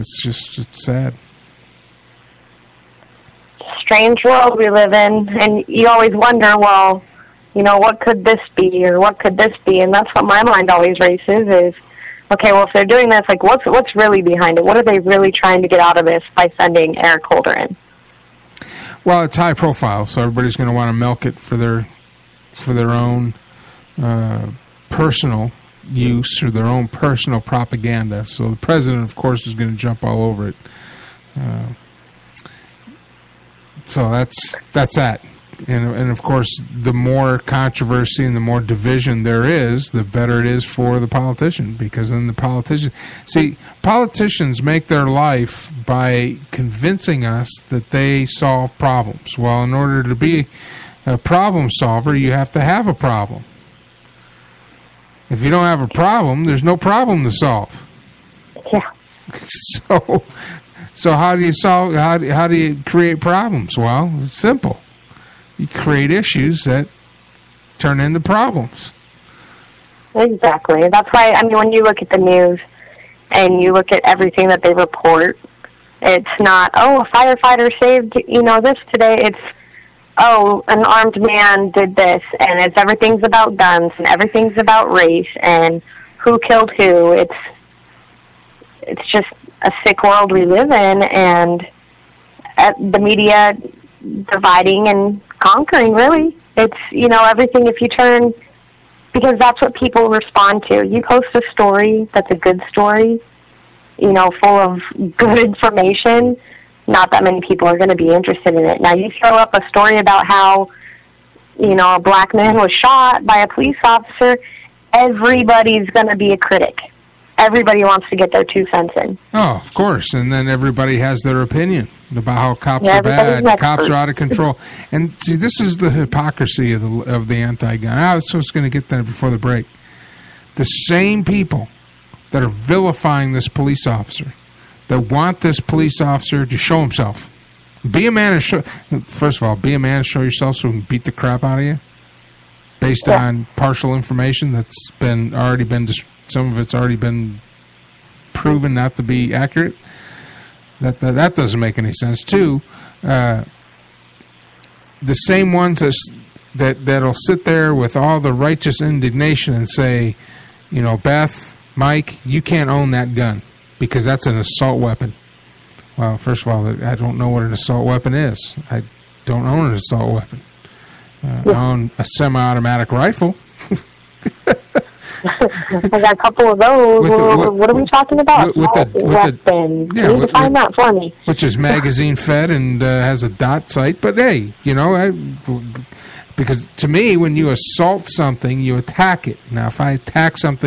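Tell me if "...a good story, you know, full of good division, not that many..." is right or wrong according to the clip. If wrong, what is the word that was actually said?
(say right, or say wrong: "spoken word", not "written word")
wrong: "information", not "division".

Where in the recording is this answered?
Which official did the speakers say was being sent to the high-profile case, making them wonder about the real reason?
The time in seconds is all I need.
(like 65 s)
17 s.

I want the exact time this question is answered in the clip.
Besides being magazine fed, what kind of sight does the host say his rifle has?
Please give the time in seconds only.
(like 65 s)
183 s.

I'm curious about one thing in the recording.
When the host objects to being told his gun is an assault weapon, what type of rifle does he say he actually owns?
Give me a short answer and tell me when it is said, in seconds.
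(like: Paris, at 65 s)
Semi-automatic rifle, at 172 s.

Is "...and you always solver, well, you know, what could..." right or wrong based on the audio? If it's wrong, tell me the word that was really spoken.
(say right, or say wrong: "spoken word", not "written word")
wrong: "wonder", not "solver".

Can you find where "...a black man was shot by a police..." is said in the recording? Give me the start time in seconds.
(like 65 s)
111 s.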